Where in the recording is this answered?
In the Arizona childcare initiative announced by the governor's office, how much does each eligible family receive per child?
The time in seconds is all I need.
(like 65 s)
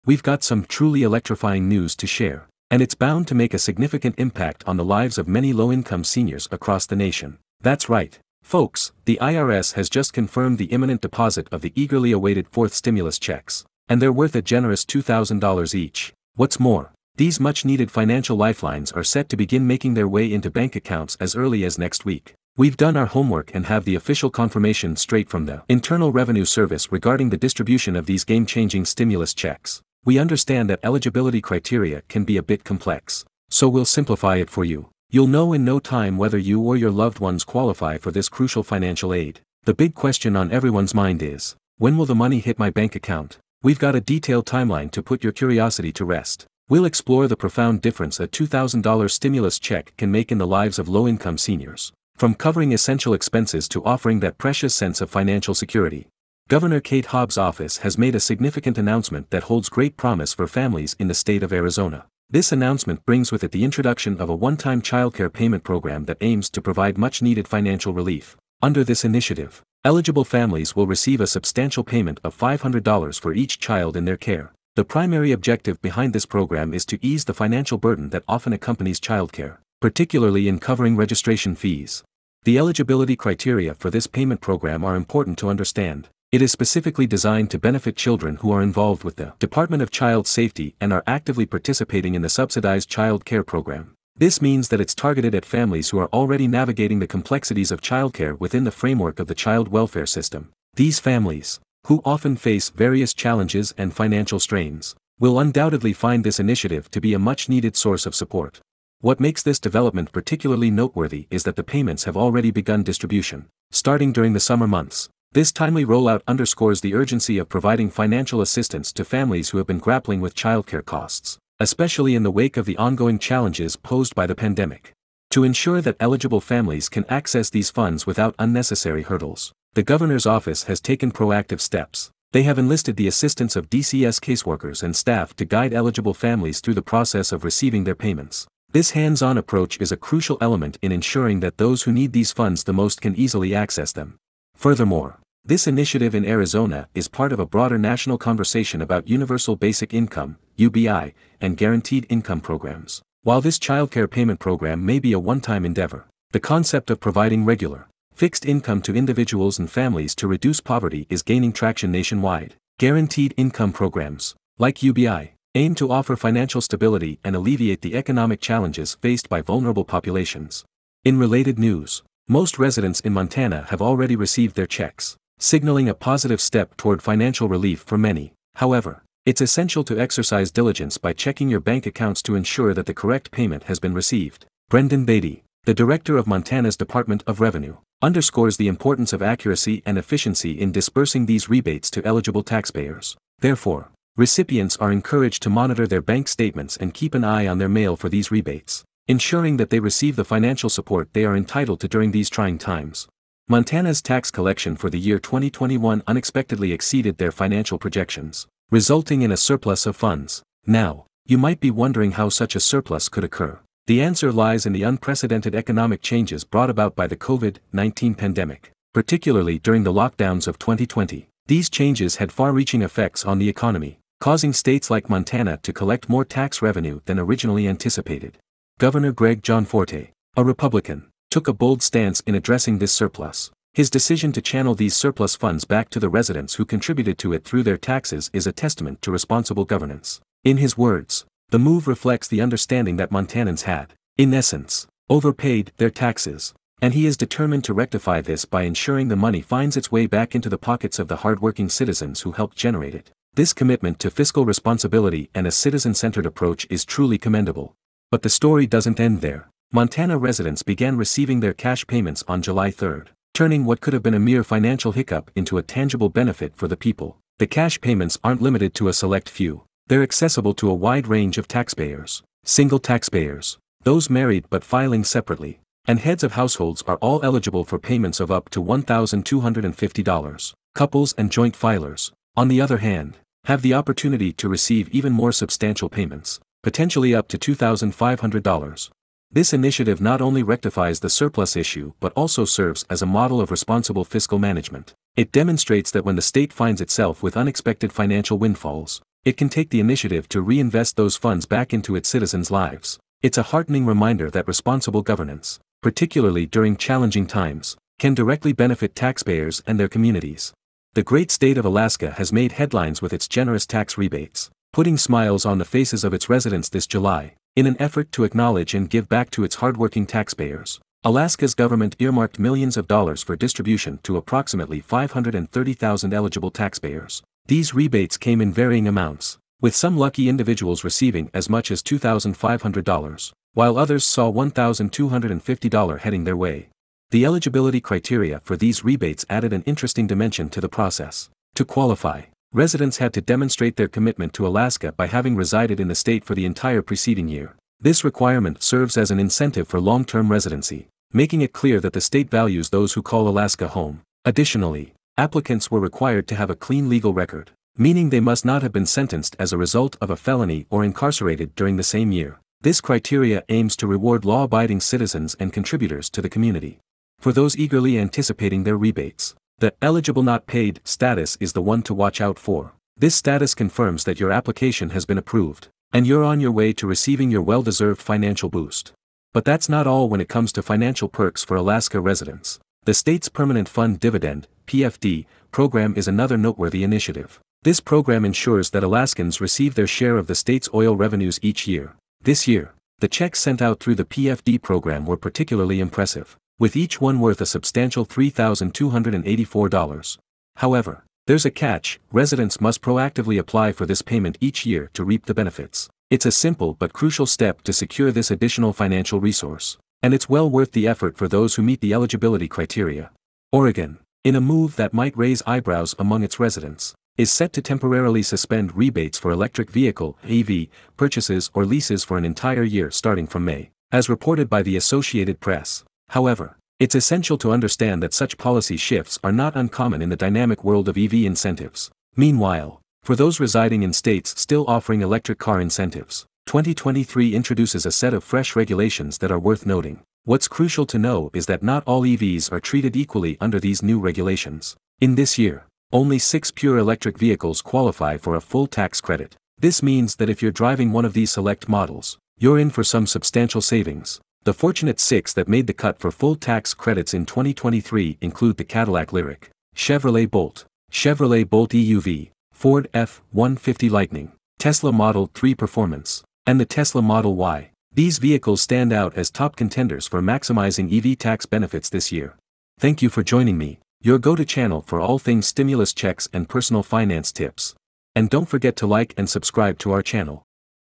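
72 s.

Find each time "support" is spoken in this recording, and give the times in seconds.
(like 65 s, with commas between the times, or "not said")
108 s, 200 s.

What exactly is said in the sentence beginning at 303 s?
It's a heartening reminder that responsible governance, particularly during challenging times, can directly benefit taxpayers and their communities.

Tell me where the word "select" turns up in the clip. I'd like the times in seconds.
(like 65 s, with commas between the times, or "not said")
268 s, 451 s.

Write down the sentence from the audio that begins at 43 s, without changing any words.
We've got a detailed timeline to put your curiosity to rest.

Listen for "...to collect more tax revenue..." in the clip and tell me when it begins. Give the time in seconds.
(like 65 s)
225 s.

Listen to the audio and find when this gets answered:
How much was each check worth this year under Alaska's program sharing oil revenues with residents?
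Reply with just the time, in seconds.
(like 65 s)
398 s.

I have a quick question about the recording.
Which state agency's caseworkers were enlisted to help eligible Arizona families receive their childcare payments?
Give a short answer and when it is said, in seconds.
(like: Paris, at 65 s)
Department of Child Safety, at 89 s.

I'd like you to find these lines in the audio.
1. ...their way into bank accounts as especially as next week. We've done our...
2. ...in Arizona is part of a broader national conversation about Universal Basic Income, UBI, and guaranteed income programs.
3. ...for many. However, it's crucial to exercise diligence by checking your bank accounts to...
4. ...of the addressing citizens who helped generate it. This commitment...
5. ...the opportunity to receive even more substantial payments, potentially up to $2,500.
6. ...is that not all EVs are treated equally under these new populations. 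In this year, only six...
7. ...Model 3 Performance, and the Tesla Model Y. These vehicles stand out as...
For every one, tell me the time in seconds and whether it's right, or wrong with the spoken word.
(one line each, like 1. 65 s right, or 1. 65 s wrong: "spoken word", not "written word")
1. 19 s wrong: "early", not "especially"
2. 146 s right
3. 177 s wrong: "essential", not "crucial"
4. 250 s wrong: "hardworking", not "addressing"
5. 283 s right
6. 441 s wrong: "regulations", not "populations"
7. 464 s right.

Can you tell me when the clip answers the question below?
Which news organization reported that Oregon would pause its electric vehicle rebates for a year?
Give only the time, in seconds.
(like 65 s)
424 s.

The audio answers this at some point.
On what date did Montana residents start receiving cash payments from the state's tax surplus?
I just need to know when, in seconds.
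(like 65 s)
262 s.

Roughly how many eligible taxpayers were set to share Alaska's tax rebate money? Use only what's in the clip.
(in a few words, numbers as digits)
530,000.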